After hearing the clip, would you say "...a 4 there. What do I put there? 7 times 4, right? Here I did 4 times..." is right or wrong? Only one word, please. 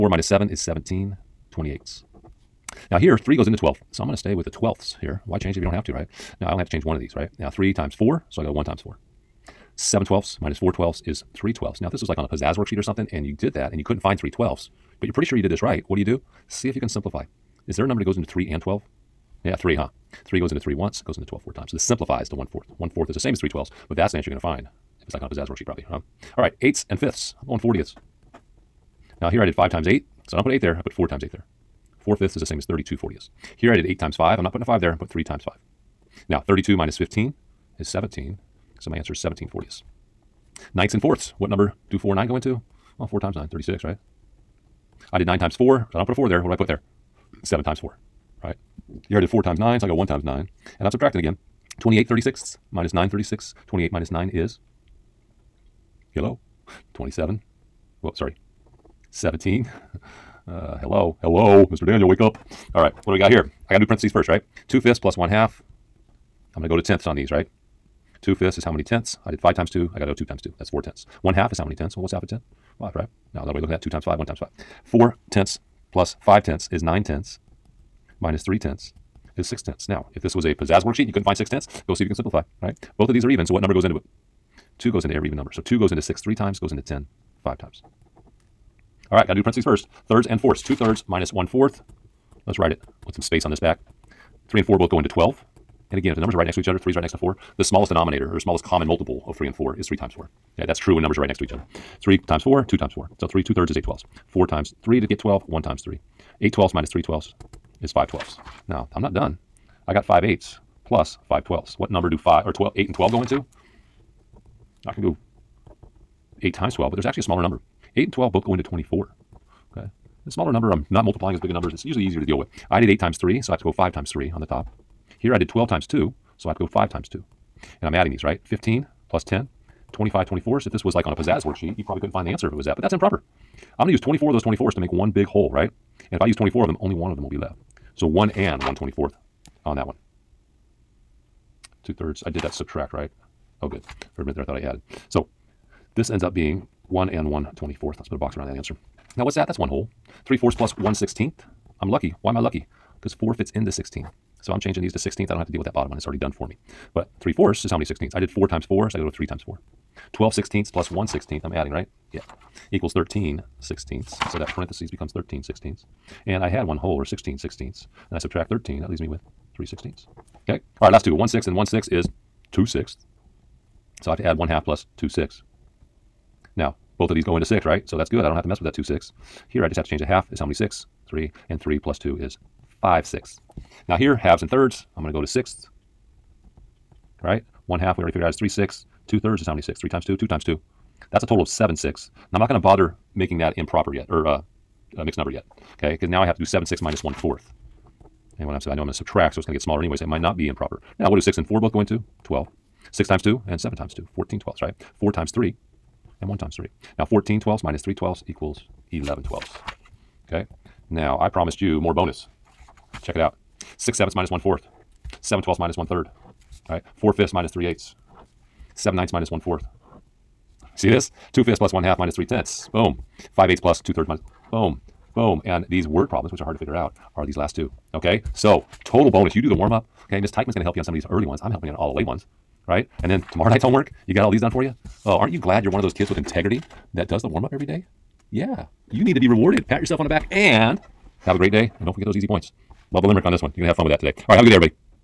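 right.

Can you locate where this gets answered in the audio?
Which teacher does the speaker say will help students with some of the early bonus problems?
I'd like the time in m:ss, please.
3:50.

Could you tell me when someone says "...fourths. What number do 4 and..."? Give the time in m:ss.
0:41.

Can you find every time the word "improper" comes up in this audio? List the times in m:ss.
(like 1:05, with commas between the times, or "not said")
2:12, 3:13, 3:20.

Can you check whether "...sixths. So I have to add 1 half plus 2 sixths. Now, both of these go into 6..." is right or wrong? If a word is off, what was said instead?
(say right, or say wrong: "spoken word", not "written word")
right.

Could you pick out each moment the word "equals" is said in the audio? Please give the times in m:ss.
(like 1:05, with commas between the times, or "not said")
2:42, 3:28.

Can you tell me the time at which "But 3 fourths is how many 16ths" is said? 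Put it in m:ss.
2:36.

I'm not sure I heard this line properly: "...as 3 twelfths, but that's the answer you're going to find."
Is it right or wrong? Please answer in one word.
right.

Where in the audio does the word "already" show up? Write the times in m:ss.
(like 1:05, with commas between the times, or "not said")
2:36, 3:08.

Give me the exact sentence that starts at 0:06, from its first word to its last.
Now I only have to change one of these, right?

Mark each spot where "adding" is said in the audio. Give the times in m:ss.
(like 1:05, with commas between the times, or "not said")
2:07, 2:41.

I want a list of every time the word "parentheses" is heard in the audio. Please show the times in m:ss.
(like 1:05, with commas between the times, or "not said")
1:03, 1:29, 2:44.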